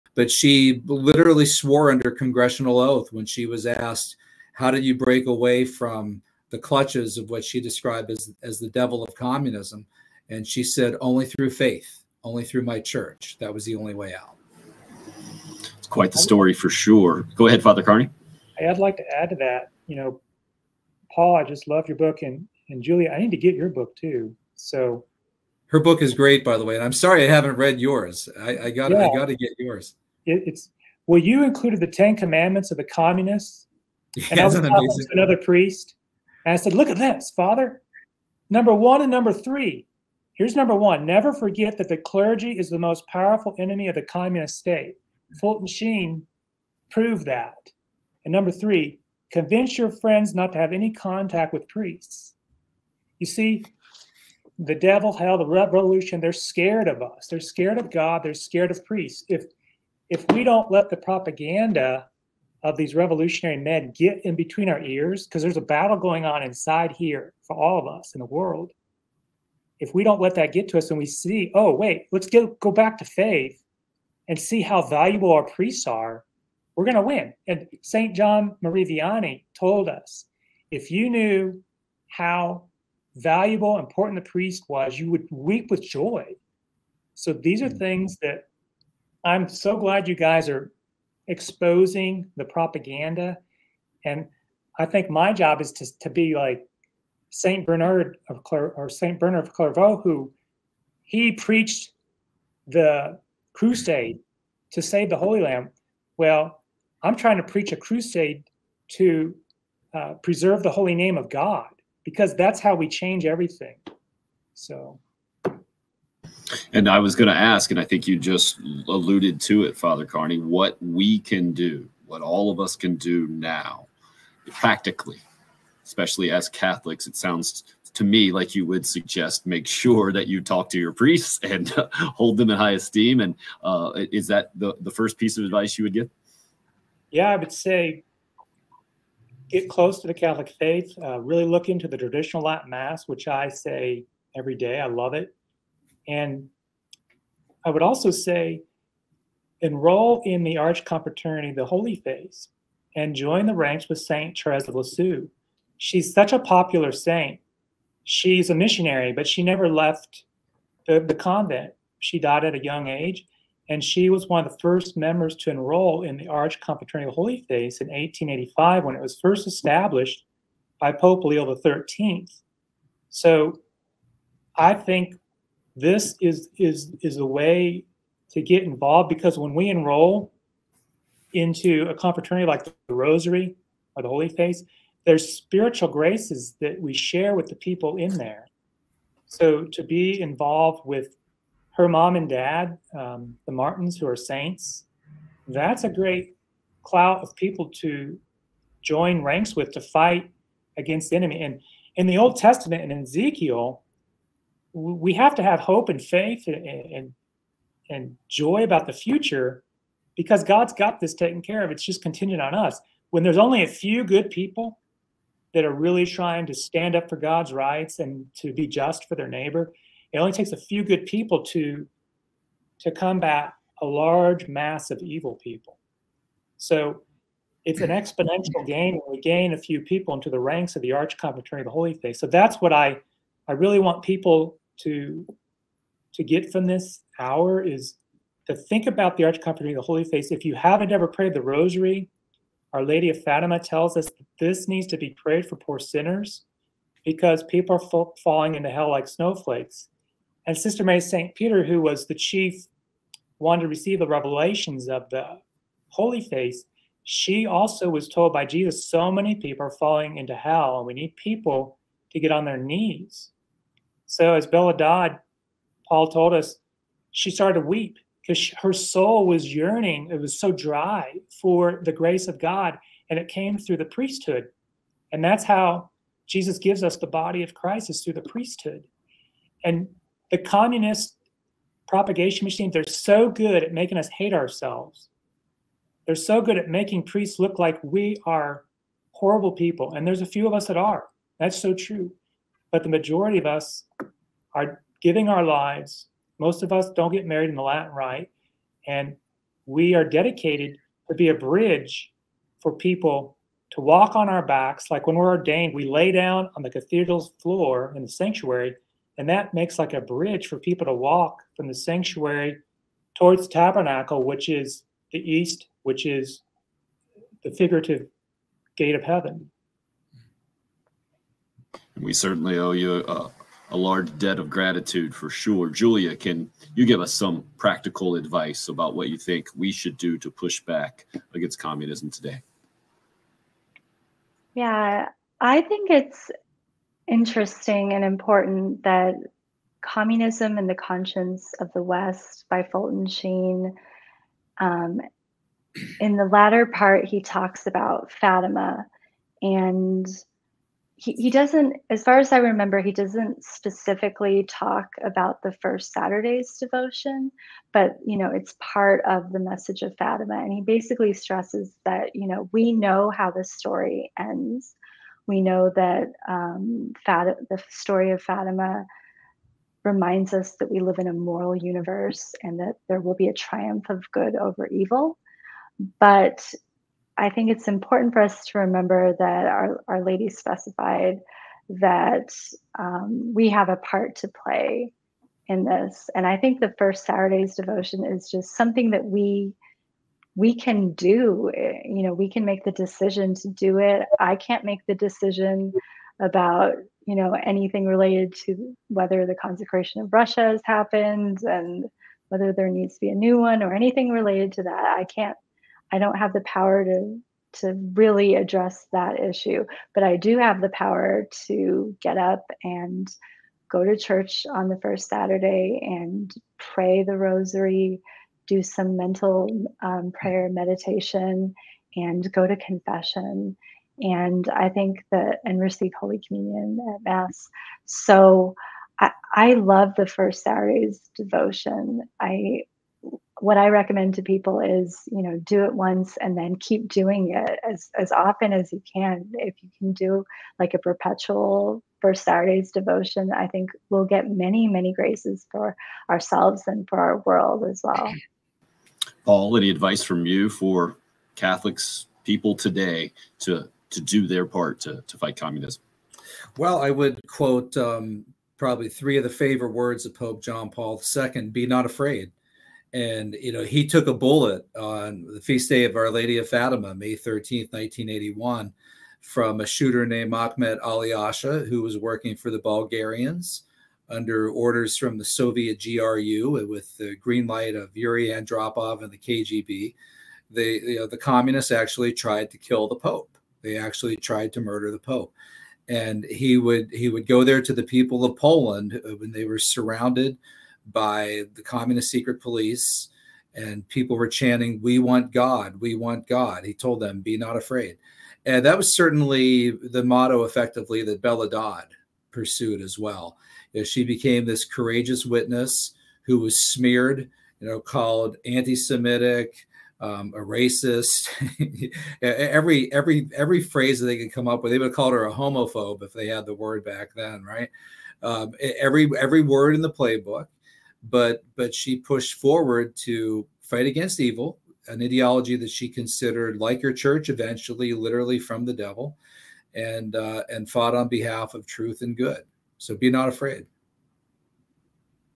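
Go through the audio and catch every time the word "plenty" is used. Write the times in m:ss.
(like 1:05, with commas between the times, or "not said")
not said.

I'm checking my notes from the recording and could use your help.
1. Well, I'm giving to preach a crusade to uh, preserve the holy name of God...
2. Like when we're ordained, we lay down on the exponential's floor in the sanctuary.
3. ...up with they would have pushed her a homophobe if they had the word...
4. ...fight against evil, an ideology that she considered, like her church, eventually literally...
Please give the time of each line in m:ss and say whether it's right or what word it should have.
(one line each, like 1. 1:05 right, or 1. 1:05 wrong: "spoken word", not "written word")
1. 1:46 wrong: "trying", not "giving"
2. 5:04 wrong: "cathedral", not "exponential"
3. 8:34 wrong: "called", not "pushed"
4. 8:43 right.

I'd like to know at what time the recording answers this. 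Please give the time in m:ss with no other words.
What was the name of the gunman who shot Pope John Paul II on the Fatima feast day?
7:50.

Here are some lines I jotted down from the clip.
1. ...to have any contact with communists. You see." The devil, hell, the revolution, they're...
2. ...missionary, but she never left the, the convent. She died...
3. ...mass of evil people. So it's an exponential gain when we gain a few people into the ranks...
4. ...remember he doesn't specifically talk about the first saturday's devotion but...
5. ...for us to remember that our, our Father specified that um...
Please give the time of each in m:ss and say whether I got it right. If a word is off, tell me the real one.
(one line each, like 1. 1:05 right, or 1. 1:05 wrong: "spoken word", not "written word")
1. 0:50 wrong: "priests", not "communists"
2. 2:38 right
3. 3:44 right
4. 5:52 right
5. 6:18 wrong: "Lady", not "Father".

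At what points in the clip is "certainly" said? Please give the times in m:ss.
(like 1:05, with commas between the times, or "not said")
5:22, 8:18.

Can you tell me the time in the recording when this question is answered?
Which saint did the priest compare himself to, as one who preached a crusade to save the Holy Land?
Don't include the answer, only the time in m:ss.
1:38.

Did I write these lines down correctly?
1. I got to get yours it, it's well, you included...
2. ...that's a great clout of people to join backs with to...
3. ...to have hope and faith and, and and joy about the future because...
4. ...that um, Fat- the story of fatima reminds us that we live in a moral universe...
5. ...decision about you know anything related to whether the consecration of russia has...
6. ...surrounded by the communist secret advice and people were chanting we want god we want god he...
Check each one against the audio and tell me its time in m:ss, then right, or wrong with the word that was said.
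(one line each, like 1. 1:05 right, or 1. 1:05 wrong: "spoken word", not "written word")
1. 0:29 right
2. 3:15 wrong: "ranks", not "backs"
3. 3:25 right
4. 6:05 right
5. 6:34 right
6. 8:09 wrong: "police", not "advice".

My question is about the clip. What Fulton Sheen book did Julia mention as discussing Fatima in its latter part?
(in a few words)
Communism and the Conscience of the West.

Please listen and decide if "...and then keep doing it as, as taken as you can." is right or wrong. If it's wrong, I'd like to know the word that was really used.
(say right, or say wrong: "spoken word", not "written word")
wrong: "often", not "taken".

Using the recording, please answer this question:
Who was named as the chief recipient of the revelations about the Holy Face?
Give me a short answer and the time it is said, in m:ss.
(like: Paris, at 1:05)
Sister Mary St. Peter, at 4:10.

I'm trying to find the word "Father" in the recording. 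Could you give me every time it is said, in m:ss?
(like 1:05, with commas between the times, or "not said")
0:17, 0:37, 1:59.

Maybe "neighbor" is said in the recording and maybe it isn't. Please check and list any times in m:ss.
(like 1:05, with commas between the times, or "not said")
3:39.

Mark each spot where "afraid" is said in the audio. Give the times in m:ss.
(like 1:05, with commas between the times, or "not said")
7:41, 8:17, 8:53.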